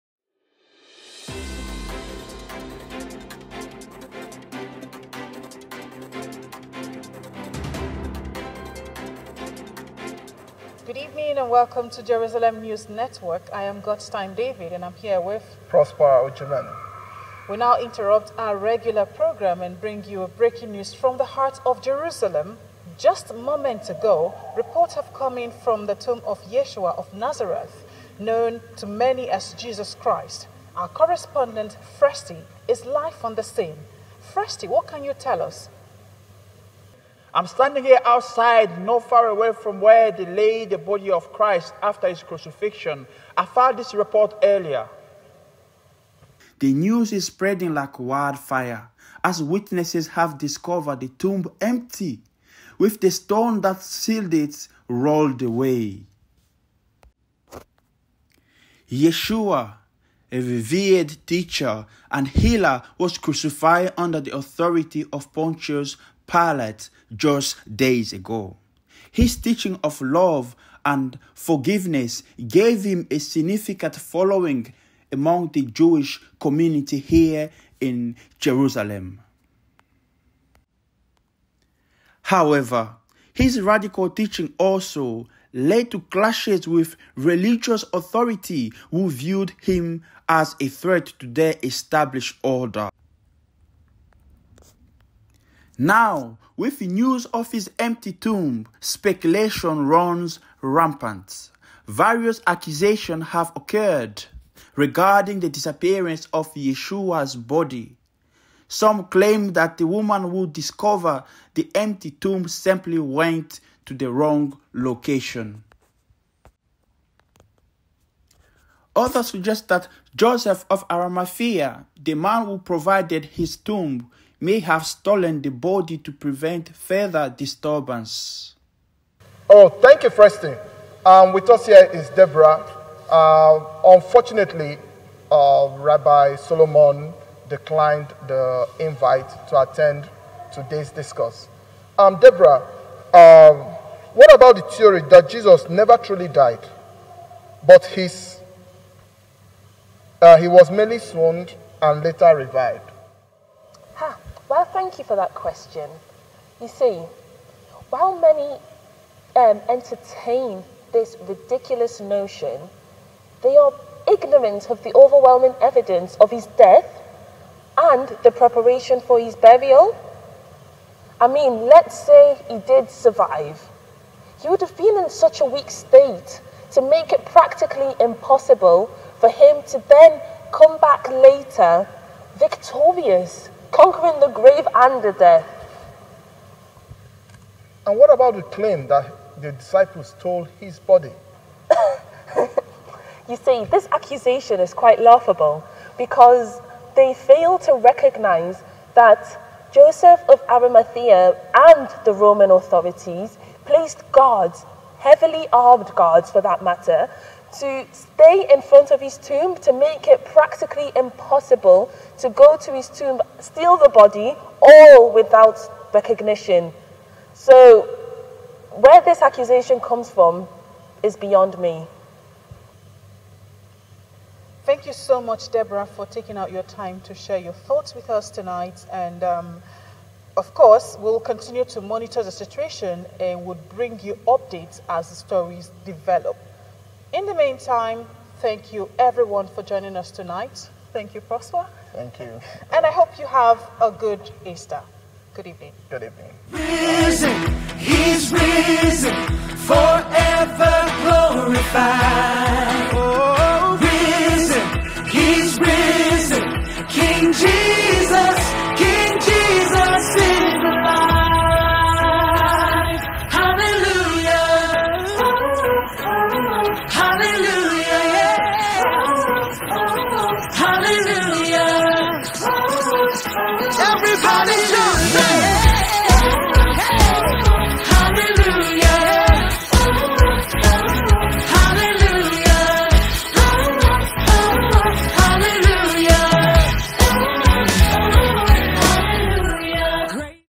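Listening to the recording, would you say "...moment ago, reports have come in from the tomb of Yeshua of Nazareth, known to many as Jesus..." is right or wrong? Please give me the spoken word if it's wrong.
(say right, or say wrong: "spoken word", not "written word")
right.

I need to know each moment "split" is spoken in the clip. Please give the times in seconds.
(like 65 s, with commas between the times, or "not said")
not said.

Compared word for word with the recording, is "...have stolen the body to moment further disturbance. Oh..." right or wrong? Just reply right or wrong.
wrong.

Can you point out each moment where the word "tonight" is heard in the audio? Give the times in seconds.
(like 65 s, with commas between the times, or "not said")
228 s, 240 s.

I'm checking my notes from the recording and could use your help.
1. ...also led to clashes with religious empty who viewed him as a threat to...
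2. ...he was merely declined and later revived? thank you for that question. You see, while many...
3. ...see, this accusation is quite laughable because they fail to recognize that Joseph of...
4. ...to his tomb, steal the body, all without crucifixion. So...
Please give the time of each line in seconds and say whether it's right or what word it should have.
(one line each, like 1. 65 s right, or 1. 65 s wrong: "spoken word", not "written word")
1. 84 s wrong: "authority", not "empty"
2. 150 s wrong: "swooned", not "declined"
3. 193 s right
4. 212 s wrong: "recognition", not "crucifixion".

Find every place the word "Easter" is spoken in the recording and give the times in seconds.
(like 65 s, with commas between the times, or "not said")
244 s.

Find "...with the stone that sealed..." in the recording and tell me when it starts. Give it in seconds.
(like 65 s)
52 s.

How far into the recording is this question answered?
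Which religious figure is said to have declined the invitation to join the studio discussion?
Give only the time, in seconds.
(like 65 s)
135 s.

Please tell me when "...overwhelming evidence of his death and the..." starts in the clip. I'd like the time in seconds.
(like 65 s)
164 s.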